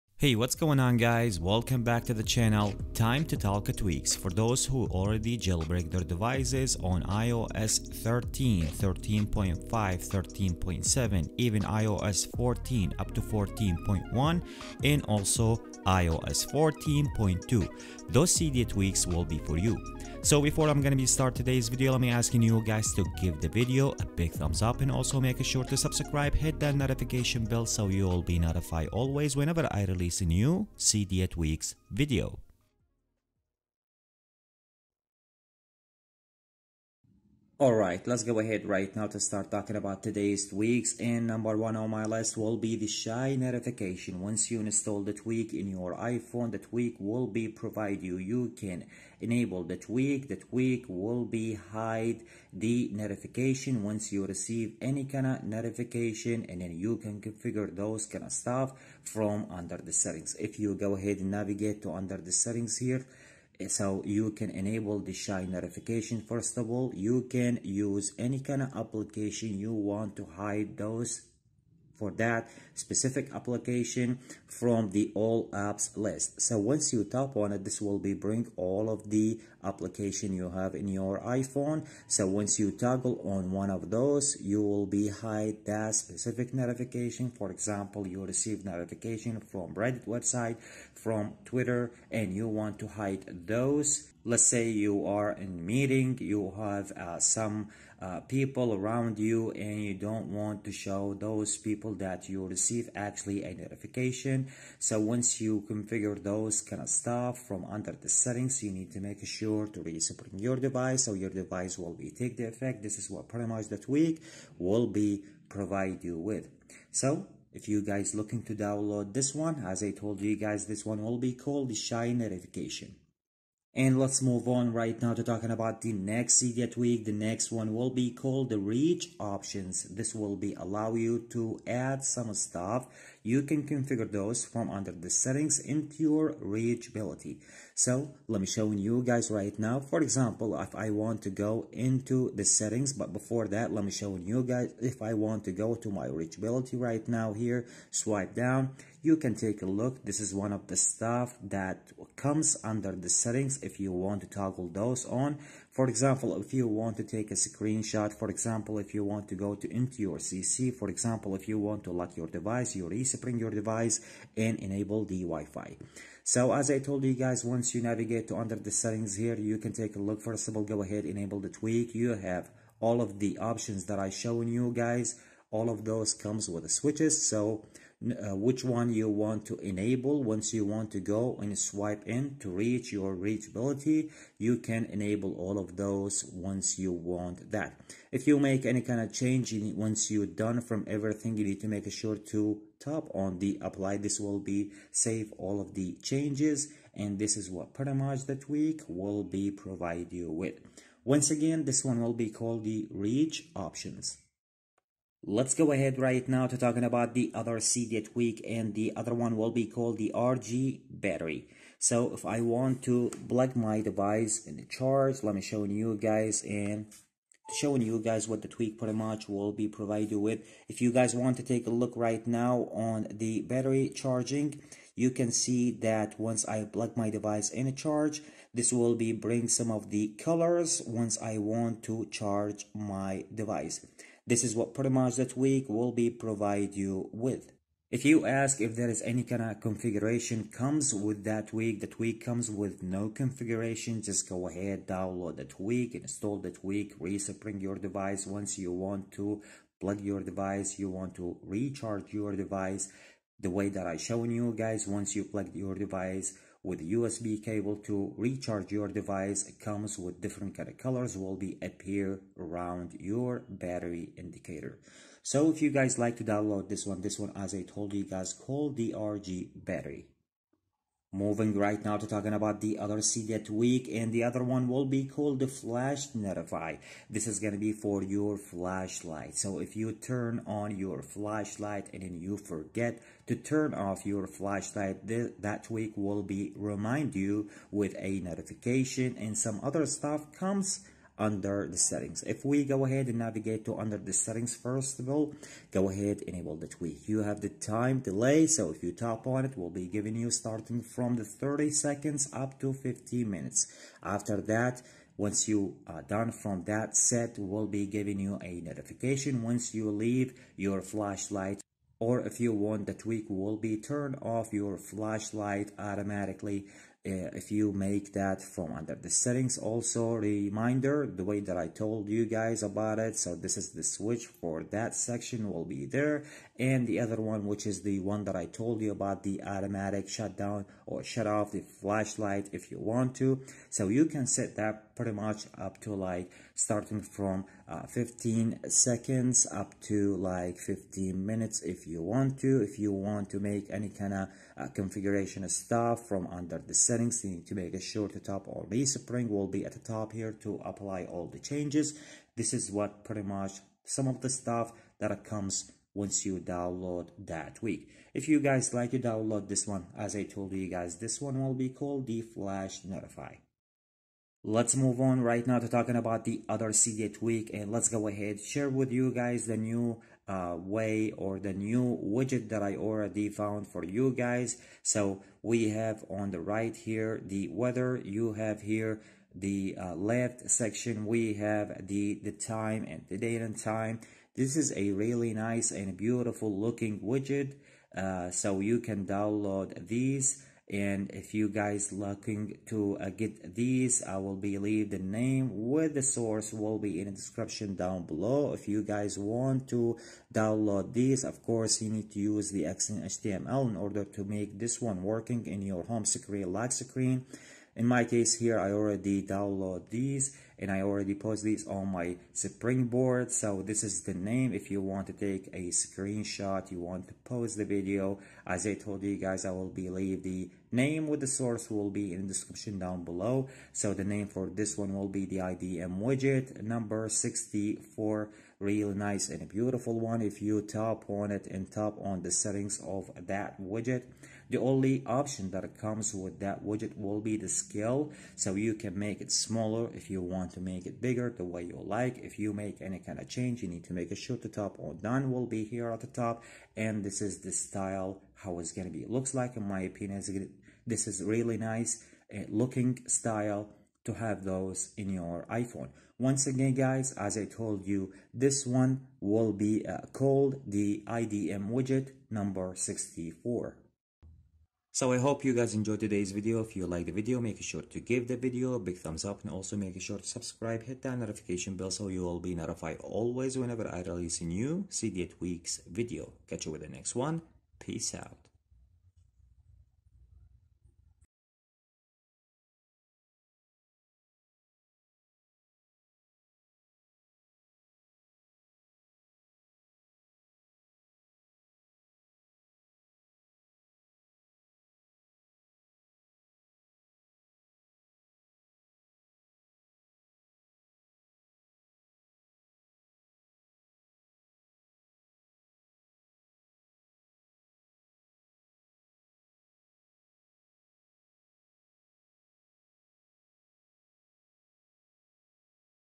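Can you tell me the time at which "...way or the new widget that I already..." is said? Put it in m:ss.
6:10.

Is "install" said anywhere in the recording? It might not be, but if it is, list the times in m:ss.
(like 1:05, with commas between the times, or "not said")
0:44, 4:05.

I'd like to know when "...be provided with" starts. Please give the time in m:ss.
3:39.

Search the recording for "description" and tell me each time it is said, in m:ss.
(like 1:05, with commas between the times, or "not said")
6:37, 7:02.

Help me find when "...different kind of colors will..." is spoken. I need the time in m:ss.
4:20.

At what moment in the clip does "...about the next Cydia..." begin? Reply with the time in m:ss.
2:05.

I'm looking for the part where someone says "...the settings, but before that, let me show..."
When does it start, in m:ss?
2:22.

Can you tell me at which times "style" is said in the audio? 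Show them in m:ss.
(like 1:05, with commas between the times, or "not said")
7:27, 7:33.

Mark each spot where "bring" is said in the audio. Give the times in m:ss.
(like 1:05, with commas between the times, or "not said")
1:18, 3:49.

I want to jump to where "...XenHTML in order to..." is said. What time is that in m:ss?
6:42.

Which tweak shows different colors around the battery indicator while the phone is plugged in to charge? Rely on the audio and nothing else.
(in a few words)
RG Battery.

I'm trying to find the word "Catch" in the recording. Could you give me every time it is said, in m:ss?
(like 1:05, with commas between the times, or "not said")
7:56.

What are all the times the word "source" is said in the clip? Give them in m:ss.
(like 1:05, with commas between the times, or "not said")
6:36, 7:01.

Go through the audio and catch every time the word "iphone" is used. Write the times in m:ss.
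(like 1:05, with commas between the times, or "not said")
0:45, 1:21, 7:35.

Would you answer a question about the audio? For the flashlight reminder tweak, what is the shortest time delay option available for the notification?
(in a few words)
30 seconds.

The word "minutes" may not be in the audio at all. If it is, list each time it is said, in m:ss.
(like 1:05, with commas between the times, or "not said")
5:03, 5:41.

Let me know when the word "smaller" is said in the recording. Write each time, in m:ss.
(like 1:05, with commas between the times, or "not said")
7:19.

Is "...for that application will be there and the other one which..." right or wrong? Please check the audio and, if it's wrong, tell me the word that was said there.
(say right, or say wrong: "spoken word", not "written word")
wrong: "section", not "application".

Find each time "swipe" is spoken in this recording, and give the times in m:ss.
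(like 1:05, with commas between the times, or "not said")
2:27, 3:01.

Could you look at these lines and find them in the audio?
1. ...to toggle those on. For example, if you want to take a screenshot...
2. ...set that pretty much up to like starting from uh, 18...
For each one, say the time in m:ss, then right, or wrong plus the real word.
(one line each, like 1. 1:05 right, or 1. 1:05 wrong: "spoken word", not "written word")
1. 2:34 right
2. 5:34 wrong: "15", not "18".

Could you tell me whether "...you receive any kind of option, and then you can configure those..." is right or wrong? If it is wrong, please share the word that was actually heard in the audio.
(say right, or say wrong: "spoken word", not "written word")
wrong: "notification", not "option".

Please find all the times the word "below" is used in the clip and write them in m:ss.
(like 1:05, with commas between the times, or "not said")
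6:38, 7:03.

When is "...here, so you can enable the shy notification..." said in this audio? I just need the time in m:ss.
1:02.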